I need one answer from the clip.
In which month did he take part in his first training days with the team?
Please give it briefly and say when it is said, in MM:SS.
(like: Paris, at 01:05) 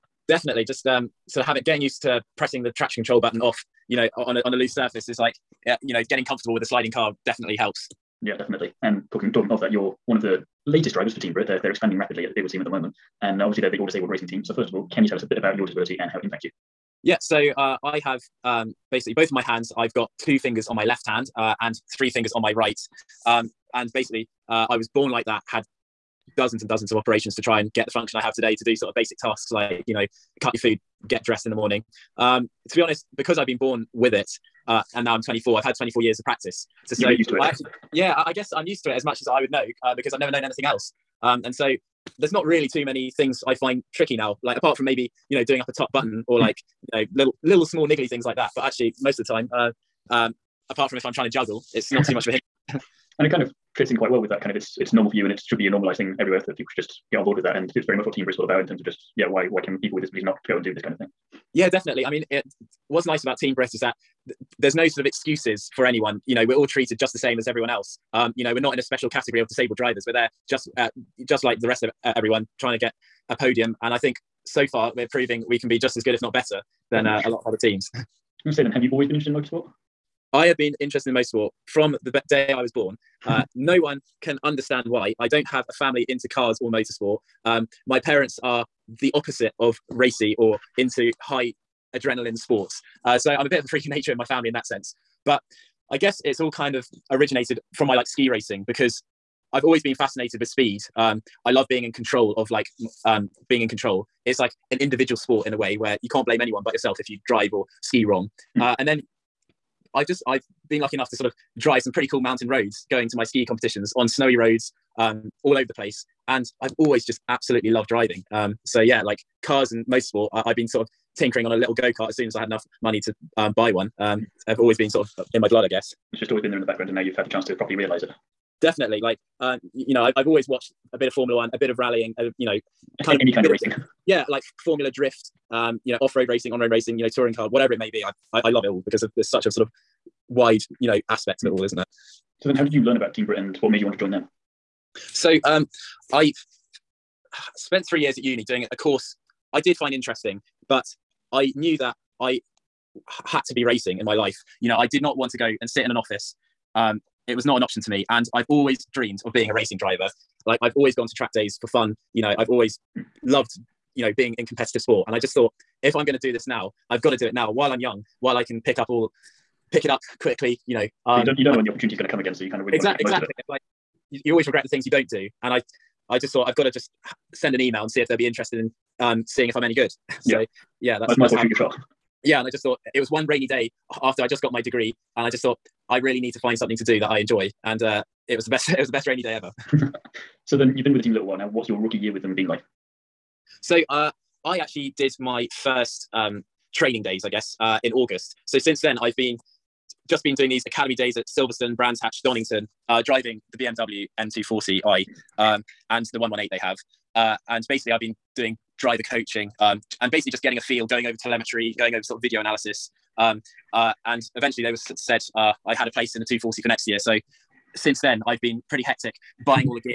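August, at 03:17.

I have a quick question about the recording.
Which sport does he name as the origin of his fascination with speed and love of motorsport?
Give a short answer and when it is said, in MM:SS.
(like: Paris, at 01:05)
Ski racing, at 01:38.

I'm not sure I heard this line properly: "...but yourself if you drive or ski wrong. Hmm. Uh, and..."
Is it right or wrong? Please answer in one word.
right.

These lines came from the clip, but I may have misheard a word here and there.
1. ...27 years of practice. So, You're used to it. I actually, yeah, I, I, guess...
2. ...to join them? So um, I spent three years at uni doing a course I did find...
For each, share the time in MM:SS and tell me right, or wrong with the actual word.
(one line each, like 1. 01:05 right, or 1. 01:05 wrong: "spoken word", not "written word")
1. 00:35 wrong: "24", not "27"
2. 02:23 right.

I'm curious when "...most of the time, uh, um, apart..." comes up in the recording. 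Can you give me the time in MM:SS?
00:49.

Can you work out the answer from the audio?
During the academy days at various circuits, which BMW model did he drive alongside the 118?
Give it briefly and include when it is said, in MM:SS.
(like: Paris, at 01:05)
BMW M240i, at 03:23.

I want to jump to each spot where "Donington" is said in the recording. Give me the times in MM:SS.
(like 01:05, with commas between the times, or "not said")
03:22.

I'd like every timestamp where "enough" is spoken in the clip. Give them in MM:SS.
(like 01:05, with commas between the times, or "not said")
01:50, 02:02.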